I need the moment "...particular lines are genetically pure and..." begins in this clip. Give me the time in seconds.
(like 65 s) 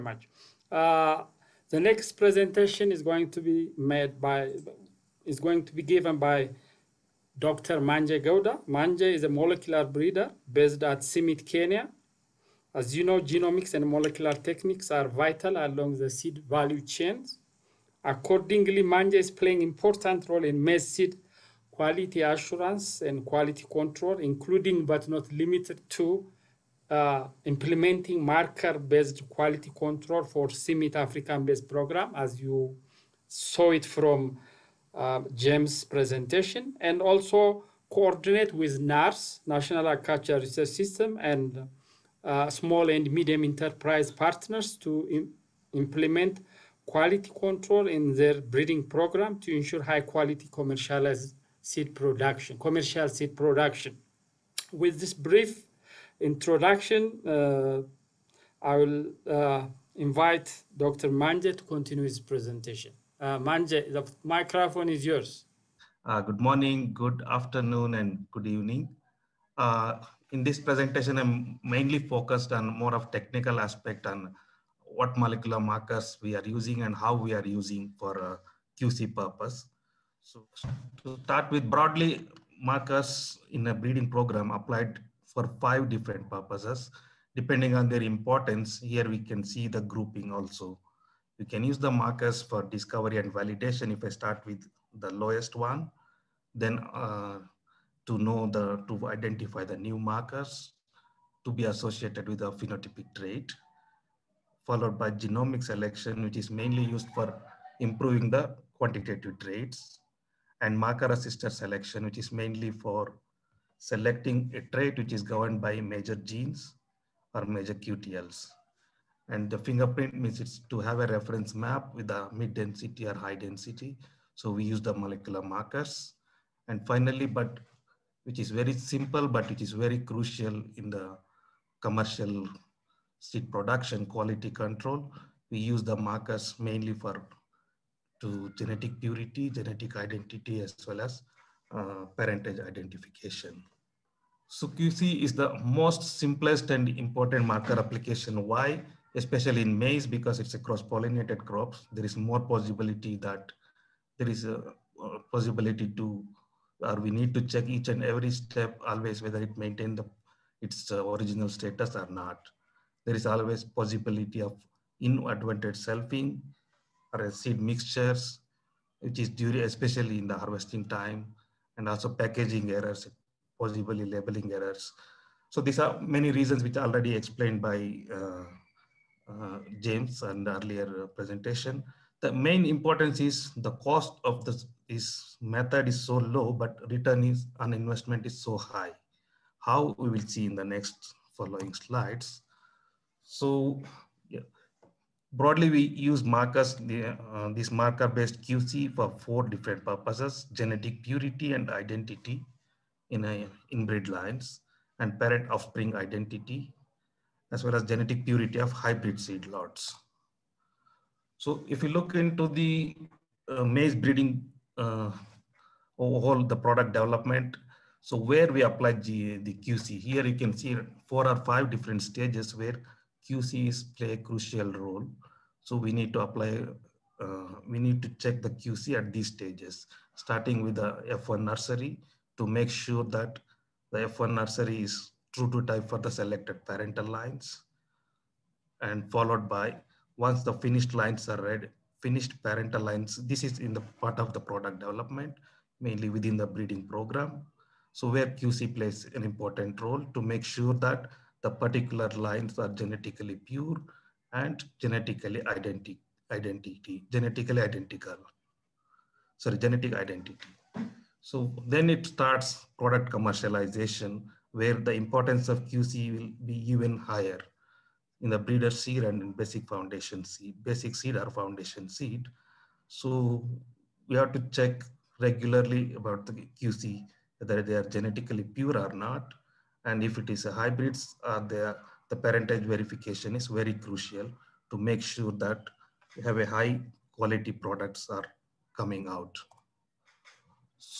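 251 s.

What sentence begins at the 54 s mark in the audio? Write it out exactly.
With this brief introduction, uh, I will uh, invite Dr.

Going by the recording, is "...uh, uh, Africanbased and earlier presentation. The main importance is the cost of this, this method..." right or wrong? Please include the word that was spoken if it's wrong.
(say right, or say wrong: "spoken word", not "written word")
wrong: "James", not "Africanbased".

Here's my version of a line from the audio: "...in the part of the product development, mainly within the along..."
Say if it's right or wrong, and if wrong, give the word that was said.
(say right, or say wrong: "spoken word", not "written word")
wrong: "breeding", not "along".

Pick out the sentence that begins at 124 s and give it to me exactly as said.
So we use the molecular markers.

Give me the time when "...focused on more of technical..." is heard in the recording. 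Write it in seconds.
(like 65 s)
72 s.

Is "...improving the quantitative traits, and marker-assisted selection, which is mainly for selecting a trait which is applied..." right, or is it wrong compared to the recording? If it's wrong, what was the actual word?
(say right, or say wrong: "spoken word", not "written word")
wrong: "governed", not "applied".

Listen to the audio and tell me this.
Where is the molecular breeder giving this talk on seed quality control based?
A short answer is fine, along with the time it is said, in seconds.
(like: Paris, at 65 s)
CIMMYT, Kenya, at 11 s.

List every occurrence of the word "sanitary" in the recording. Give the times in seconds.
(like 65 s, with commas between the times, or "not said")
not said.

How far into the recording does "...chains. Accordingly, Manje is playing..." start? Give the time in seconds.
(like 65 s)
16 s.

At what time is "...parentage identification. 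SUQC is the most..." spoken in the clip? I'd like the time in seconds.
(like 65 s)
142 s.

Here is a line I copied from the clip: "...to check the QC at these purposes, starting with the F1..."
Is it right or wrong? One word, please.
wrong.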